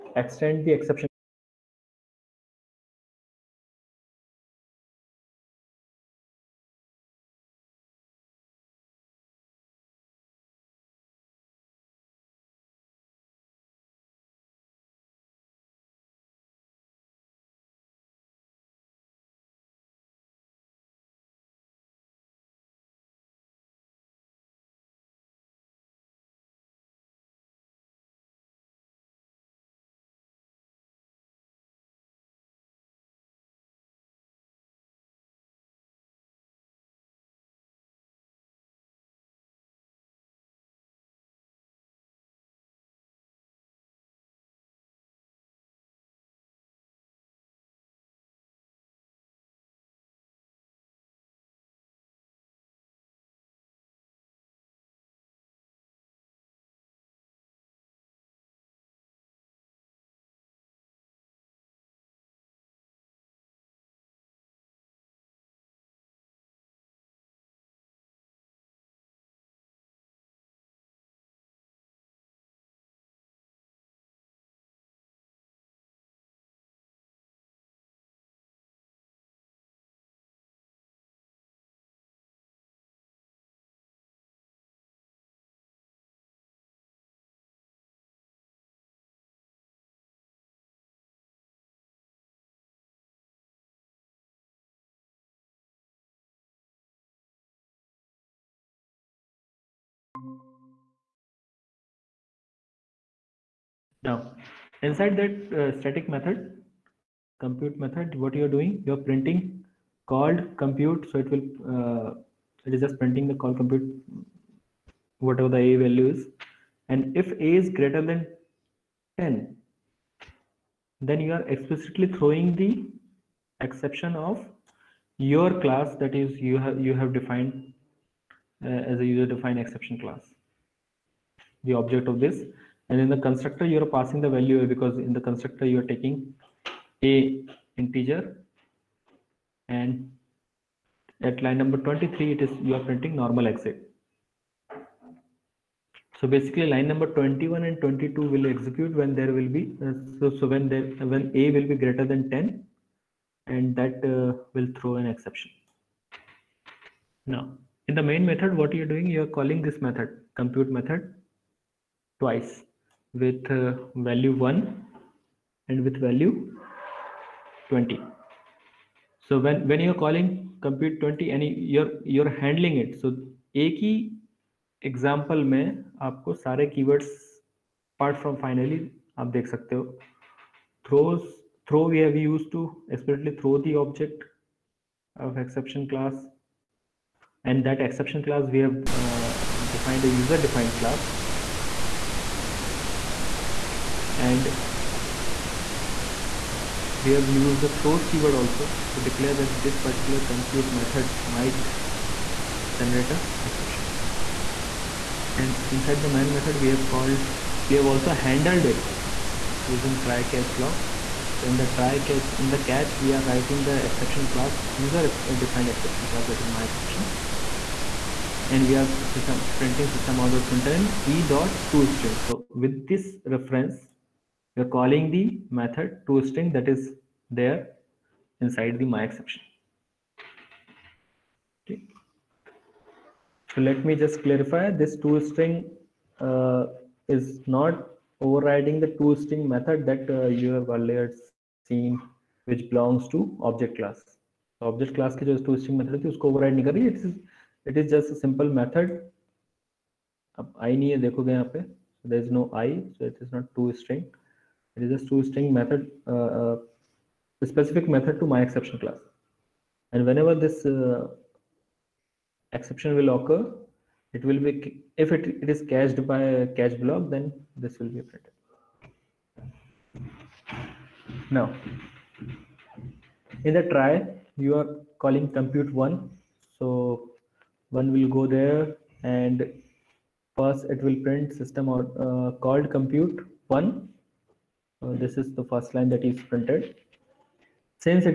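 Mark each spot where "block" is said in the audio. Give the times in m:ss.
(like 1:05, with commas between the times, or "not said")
3:30, 4:26.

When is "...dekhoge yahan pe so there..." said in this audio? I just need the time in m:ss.
4:11.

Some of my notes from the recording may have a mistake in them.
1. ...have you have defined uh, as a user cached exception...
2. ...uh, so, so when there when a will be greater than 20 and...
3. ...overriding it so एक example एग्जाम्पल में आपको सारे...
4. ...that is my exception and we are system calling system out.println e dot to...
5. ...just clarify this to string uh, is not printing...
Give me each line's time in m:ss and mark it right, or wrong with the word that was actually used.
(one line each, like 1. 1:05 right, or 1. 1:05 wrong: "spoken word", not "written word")
1. 2:06 wrong: "defined", not "cached"
2. 2:29 wrong: "10", not "20"
3. 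2:52 wrong: "handling", not "overriding"
4. 3:36 wrong: "printing", not "calling"
5. 3:53 wrong: "overriding", not "printing".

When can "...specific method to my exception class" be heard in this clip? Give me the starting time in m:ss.
4:17.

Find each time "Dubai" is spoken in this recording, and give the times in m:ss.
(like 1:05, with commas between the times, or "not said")
not said.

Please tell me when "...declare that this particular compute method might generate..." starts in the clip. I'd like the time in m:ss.
3:19.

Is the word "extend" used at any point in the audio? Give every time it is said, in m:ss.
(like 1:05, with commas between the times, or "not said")
0:00.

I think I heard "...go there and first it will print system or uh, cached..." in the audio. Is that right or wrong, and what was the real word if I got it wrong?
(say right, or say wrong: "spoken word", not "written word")
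wrong: "called", not "cached".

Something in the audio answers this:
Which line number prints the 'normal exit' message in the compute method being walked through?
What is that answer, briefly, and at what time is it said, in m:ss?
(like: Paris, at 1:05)
23, at 2:21.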